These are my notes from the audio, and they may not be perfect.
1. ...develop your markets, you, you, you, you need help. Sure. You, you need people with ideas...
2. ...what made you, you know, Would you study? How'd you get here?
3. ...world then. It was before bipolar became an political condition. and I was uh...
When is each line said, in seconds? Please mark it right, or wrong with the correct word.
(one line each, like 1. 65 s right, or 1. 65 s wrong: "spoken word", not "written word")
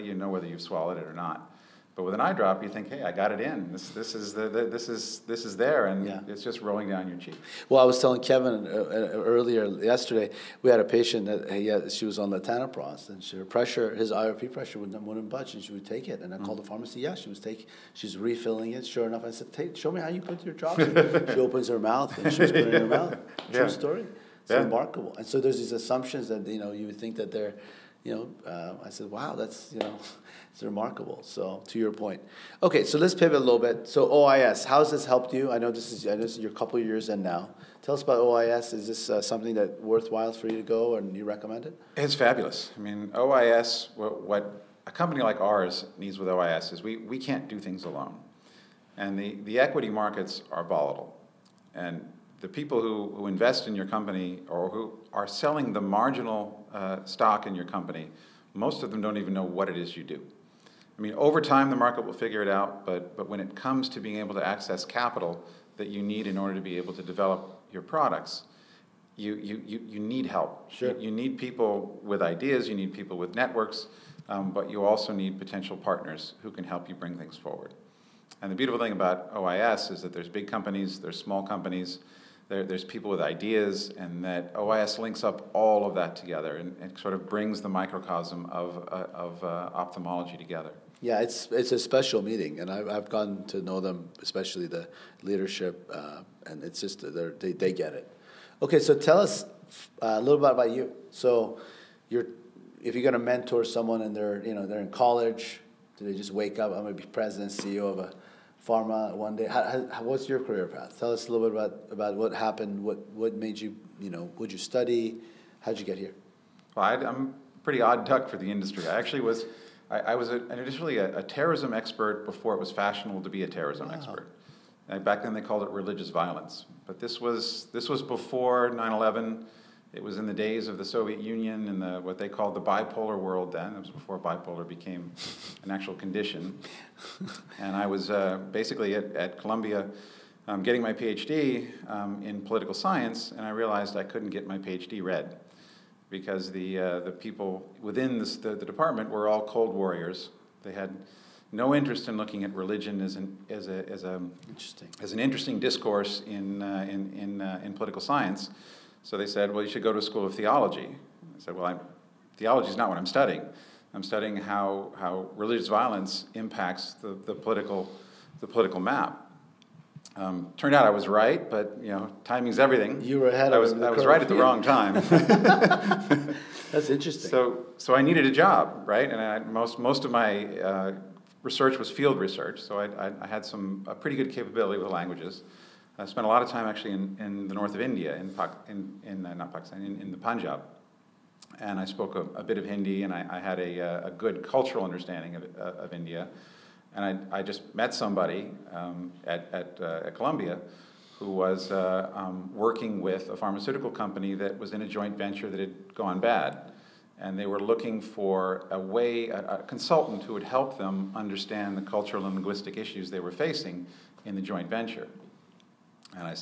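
1. 67 s wrong: "products", not "markets"
2. 113 s right
3. 133 s wrong: "actual", not "political".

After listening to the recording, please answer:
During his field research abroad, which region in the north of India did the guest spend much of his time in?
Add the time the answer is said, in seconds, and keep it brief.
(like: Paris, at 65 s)
the Punjab, at 190 s.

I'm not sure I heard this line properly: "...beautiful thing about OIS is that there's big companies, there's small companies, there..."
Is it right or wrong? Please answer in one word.
right.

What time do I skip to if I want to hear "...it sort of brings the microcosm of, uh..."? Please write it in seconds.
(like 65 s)
86 s.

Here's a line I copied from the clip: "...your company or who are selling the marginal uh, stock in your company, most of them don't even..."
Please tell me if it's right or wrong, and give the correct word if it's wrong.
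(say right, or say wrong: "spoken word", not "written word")
right.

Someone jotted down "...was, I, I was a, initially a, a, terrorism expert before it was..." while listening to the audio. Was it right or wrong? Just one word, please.
right.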